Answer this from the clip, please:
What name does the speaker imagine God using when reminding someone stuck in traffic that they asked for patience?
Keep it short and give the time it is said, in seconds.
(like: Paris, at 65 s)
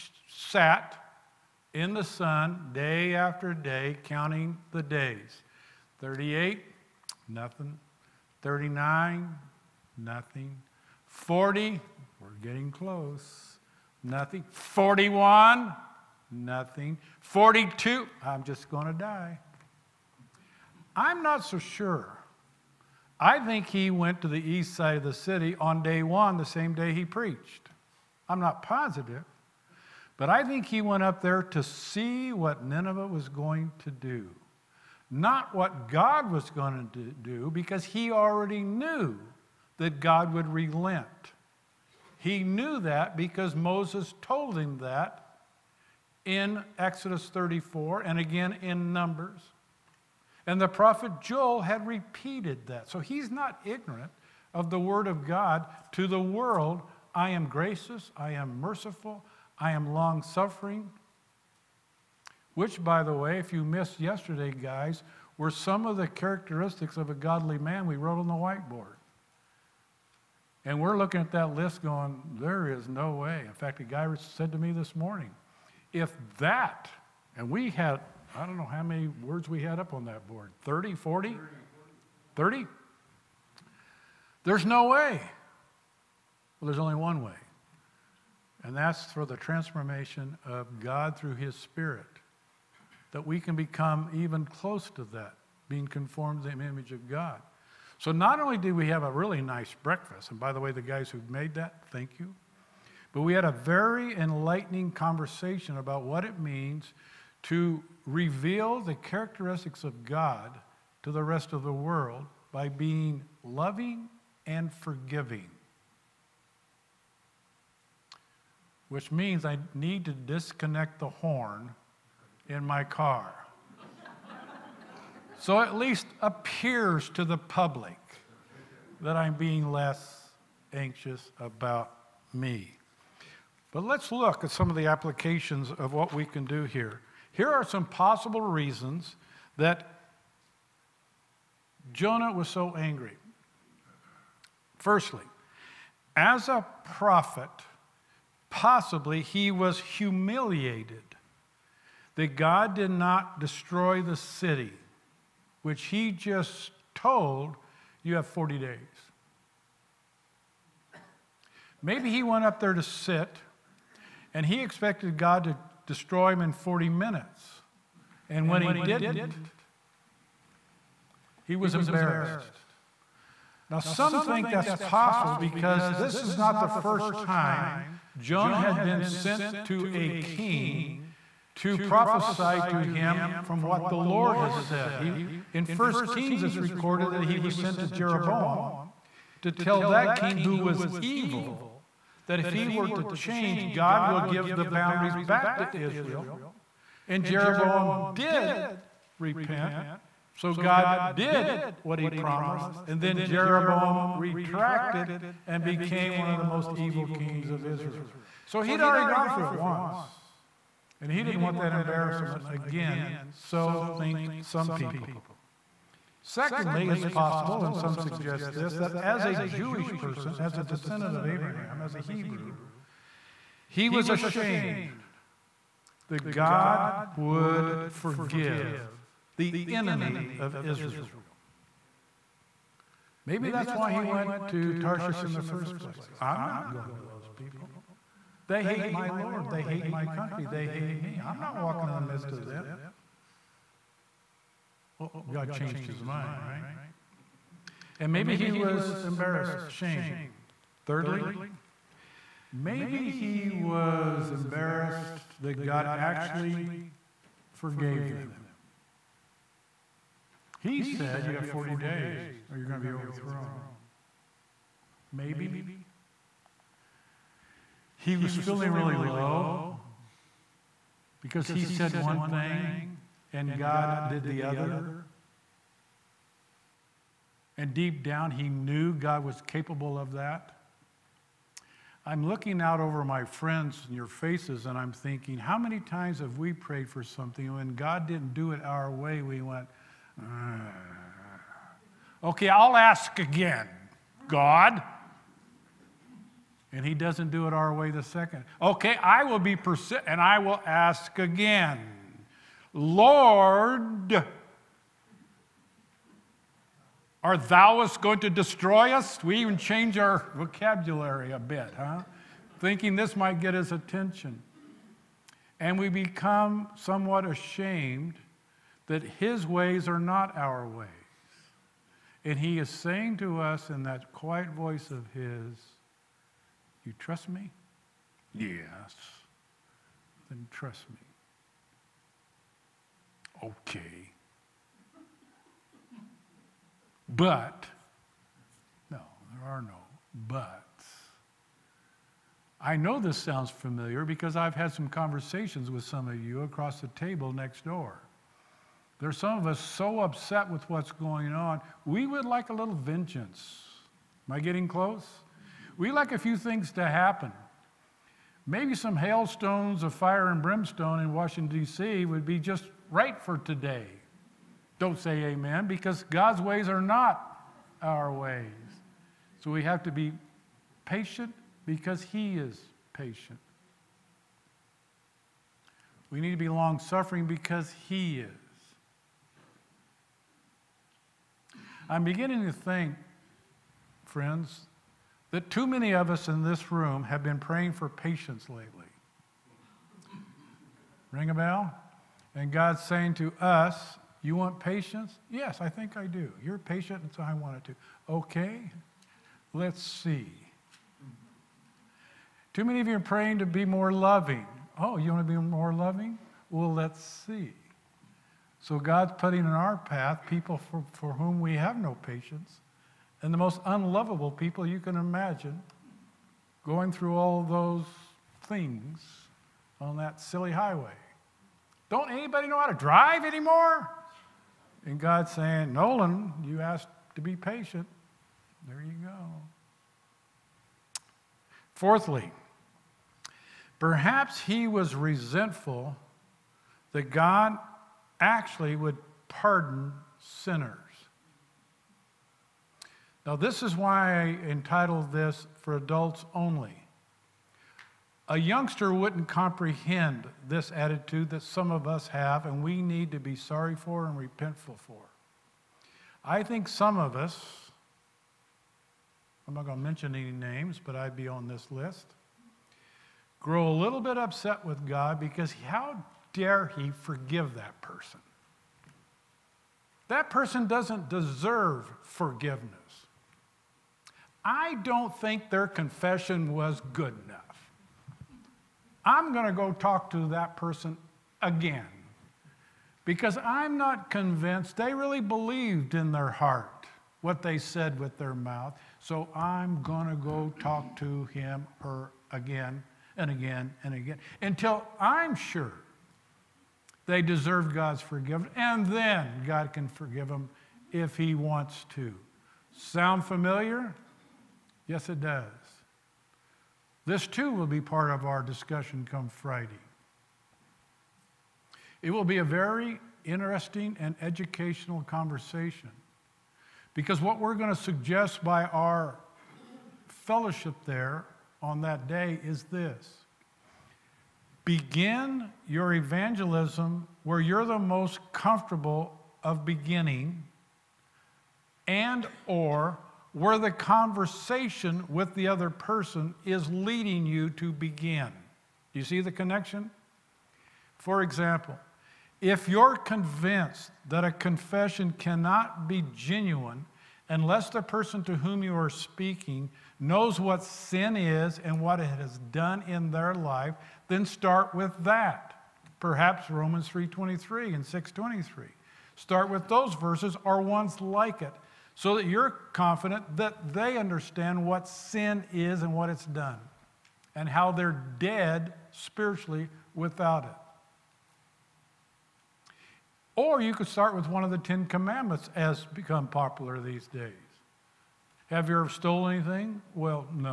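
Nolan, at 425 s.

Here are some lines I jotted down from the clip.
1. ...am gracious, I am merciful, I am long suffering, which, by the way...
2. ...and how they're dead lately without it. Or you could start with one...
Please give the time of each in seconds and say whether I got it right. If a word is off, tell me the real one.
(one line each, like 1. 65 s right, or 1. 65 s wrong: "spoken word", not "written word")
1. 57 s right
2. 567 s wrong: "spiritually", not "lately".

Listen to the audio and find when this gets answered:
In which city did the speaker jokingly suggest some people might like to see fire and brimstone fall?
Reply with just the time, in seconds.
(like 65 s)
361 s.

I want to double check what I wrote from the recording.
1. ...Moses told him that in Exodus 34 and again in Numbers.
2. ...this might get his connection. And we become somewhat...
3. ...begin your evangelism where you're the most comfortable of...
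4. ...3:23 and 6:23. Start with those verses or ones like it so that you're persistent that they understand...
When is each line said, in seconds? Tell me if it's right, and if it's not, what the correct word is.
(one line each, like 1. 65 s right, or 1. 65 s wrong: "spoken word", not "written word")
1. 43 s right
2. 312 s wrong: "attention", not "connection"
3. 524 s right
4. 556 s wrong: "confident", not "persistent".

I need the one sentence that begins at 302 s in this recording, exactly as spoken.
Lord, are thou us going to destroy us?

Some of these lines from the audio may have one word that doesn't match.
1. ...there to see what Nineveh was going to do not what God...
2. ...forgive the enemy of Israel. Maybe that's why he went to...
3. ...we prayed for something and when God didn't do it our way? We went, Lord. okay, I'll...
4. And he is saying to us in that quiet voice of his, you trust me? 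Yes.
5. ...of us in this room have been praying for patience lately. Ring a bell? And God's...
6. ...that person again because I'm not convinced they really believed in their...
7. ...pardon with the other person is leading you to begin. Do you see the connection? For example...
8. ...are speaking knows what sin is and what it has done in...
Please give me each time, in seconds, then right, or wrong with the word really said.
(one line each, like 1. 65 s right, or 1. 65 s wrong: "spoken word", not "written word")
1. 31 s right
2. 227 s right
3. 286 s wrong: "Ugh", not "Lord"
4. 322 s right
5. 385 s right
6. 480 s right
7. 533 s wrong: "conversation", not "pardon"
8. 548 s right.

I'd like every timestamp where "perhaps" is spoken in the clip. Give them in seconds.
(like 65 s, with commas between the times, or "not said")
433 s, 555 s.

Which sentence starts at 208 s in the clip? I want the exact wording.
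So he'd already gone through it once.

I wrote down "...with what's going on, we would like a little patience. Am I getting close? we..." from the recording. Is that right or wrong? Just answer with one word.
wrong.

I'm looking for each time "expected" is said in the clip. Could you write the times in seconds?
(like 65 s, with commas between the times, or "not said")
164 s.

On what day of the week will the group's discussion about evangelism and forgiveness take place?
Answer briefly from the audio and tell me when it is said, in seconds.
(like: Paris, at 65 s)
Friday, at 509 s.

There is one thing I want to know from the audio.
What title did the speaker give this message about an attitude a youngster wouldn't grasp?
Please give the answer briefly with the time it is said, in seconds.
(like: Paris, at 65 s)
For Adults Only, at 445 s.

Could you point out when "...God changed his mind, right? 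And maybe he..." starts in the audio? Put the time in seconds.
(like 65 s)
245 s.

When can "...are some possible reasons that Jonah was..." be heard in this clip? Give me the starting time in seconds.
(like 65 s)
137 s.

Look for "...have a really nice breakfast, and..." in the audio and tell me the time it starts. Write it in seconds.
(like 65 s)
98 s.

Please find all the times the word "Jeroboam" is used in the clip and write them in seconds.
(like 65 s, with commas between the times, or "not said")
187 s, 197 s, 203 s.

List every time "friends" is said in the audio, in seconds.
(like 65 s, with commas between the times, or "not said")
283 s, 384 s.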